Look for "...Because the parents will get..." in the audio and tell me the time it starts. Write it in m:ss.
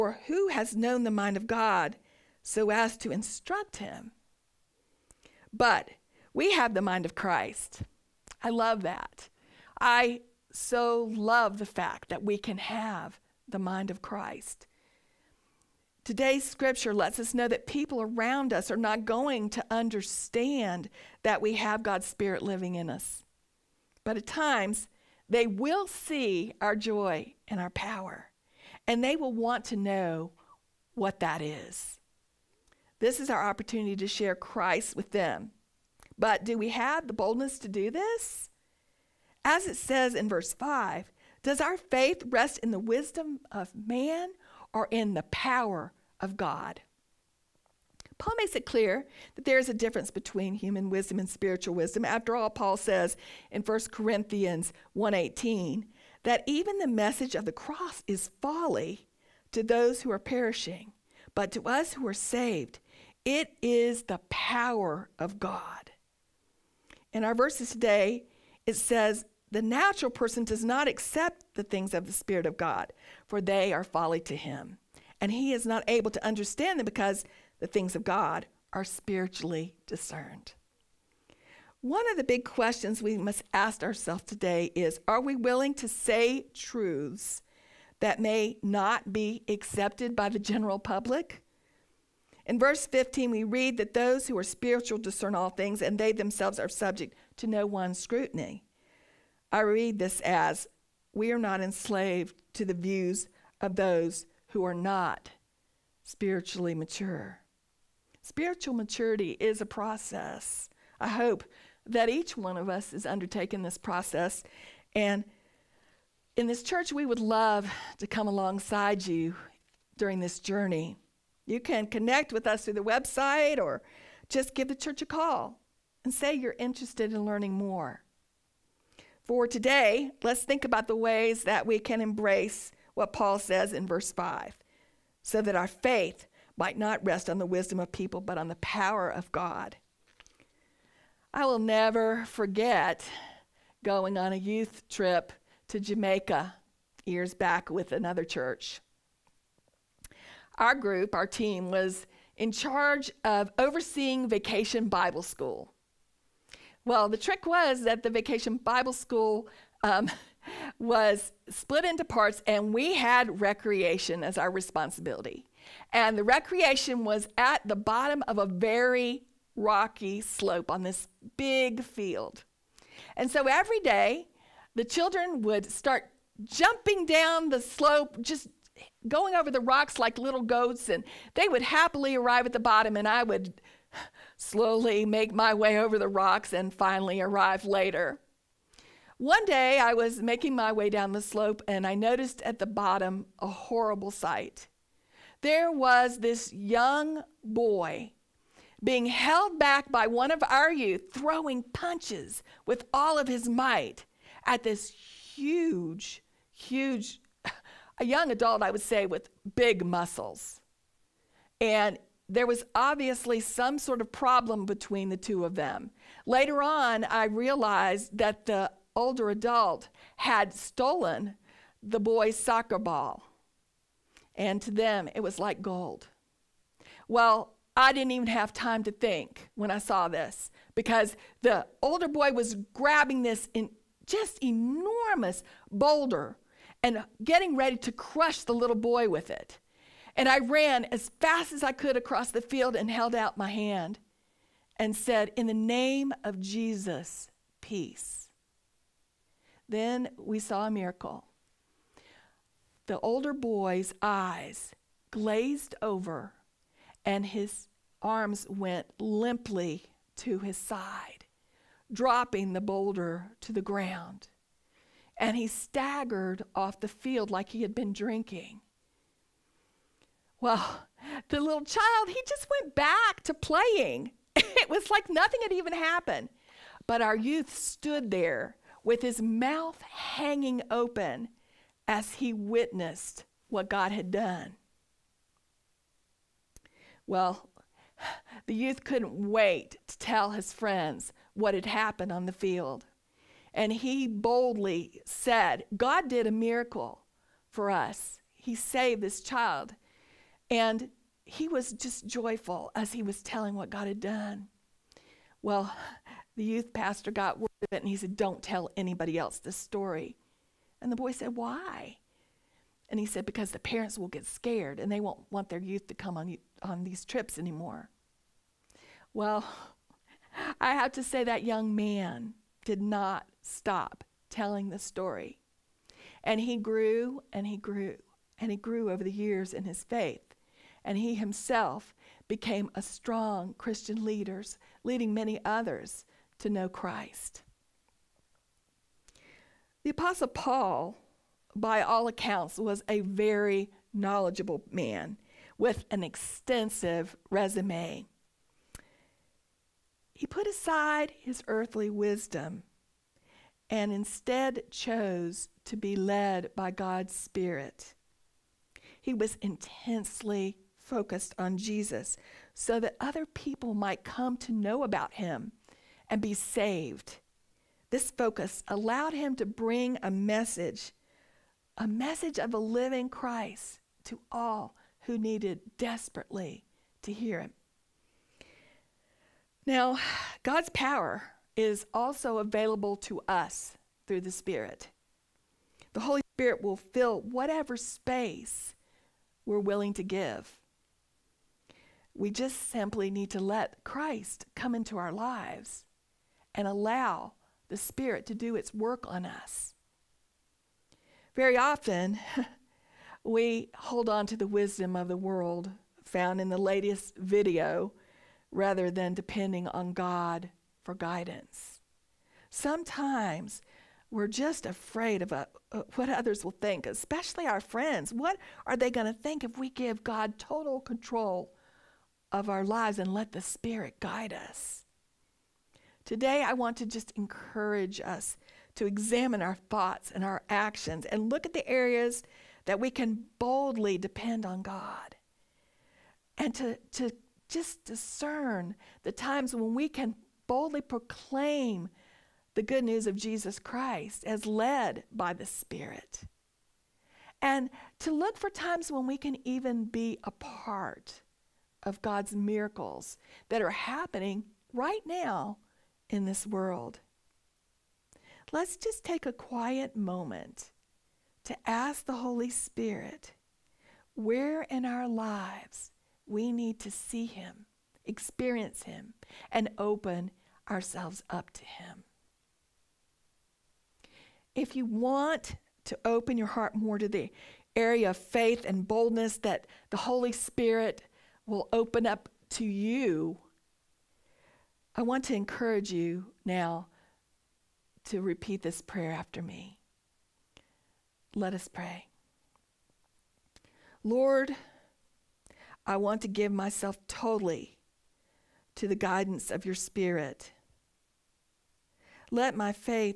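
5:13.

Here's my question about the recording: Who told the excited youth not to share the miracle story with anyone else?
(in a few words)
The youth pastor.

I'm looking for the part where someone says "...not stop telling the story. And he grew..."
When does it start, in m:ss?
5:22.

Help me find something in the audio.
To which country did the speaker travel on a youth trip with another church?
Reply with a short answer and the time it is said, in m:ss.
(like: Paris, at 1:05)
Jamaica, at 2:25.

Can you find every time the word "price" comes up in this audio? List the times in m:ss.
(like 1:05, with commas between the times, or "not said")
not said.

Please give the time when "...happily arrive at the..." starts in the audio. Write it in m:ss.
3:01.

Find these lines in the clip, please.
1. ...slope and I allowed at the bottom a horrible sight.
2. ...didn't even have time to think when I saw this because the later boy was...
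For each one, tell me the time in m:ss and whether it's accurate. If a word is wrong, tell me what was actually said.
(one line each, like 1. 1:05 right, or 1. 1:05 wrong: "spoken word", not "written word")
1. 3:11 wrong: "noticed", not "allowed"
2. 3:47 wrong: "older", not "later".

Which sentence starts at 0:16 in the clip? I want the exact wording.
Today's scripture lets us know that people around us are not going to understand that we have God's Spirit living in us.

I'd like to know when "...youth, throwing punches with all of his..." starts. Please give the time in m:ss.
3:20.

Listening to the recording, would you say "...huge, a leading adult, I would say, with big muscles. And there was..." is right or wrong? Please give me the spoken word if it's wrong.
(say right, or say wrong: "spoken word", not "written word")
wrong: "young", not "leading".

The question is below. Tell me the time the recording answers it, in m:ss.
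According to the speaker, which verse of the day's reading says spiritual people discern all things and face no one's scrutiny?
1:32.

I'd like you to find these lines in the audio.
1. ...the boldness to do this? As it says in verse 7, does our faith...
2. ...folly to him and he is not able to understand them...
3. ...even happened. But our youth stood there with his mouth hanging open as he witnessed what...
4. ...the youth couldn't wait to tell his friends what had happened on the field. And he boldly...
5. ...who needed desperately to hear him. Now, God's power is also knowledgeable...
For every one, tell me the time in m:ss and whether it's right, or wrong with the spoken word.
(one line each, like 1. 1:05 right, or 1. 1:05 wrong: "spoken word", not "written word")
1. 0:37 wrong: "5", not "7"
2. 1:13 right
3. 4:35 right
4. 4:48 right
5. 6:15 wrong: "available", not "knowledgeable".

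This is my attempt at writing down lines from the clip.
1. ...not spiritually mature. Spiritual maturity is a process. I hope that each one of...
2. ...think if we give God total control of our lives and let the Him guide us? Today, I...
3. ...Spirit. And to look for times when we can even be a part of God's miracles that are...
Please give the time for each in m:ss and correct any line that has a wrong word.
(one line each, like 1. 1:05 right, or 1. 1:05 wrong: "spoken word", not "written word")
1. 1:44 right
2. 6:59 wrong: "Spirit", not "Him"
3. 7:25 right.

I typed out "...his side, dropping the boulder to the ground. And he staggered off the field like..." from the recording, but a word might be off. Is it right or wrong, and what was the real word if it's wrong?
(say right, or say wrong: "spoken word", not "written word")
right.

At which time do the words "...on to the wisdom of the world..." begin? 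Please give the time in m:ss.
6:44.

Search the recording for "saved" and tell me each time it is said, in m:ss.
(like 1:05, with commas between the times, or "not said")
1:02, 4:58, 6:06.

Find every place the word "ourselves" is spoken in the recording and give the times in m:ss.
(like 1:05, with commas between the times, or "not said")
1:23, 7:50.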